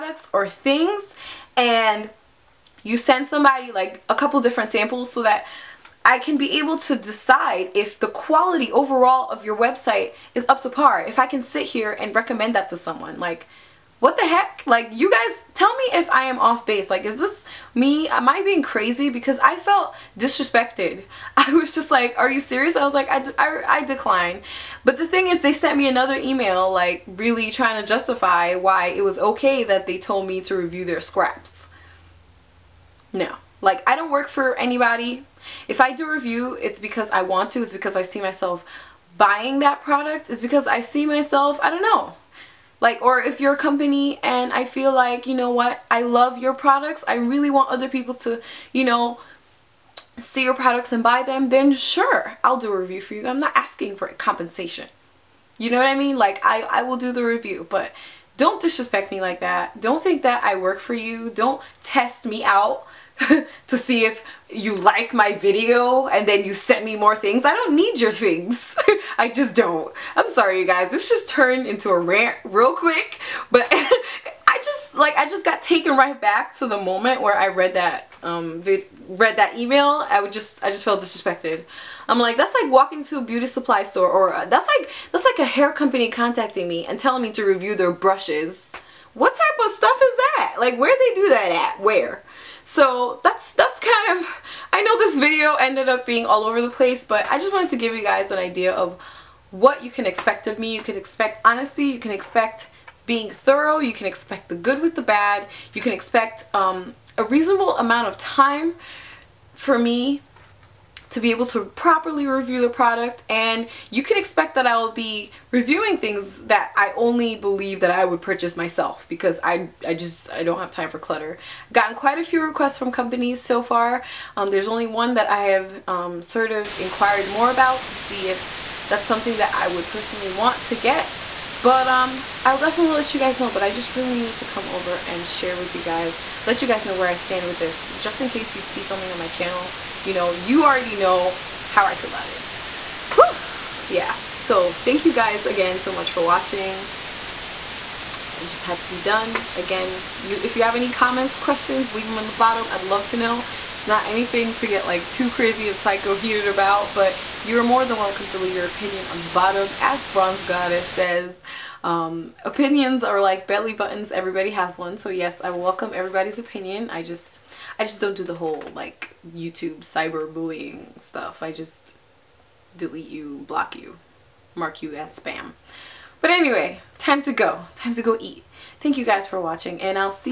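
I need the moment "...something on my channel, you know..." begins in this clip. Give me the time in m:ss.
2:18.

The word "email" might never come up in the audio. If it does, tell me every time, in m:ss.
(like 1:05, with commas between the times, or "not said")
0:26, 1:19.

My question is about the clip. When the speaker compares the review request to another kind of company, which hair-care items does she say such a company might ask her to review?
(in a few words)
brushes.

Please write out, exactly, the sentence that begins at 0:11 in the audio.
If I can sit here and recommend that to someone, like, what the heck?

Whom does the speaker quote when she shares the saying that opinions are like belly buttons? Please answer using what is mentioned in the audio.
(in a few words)
Bronze Goddess.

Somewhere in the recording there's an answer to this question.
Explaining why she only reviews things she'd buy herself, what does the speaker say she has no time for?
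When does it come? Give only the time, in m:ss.
2:00.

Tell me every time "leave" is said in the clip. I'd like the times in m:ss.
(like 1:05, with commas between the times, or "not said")
2:31, 2:38.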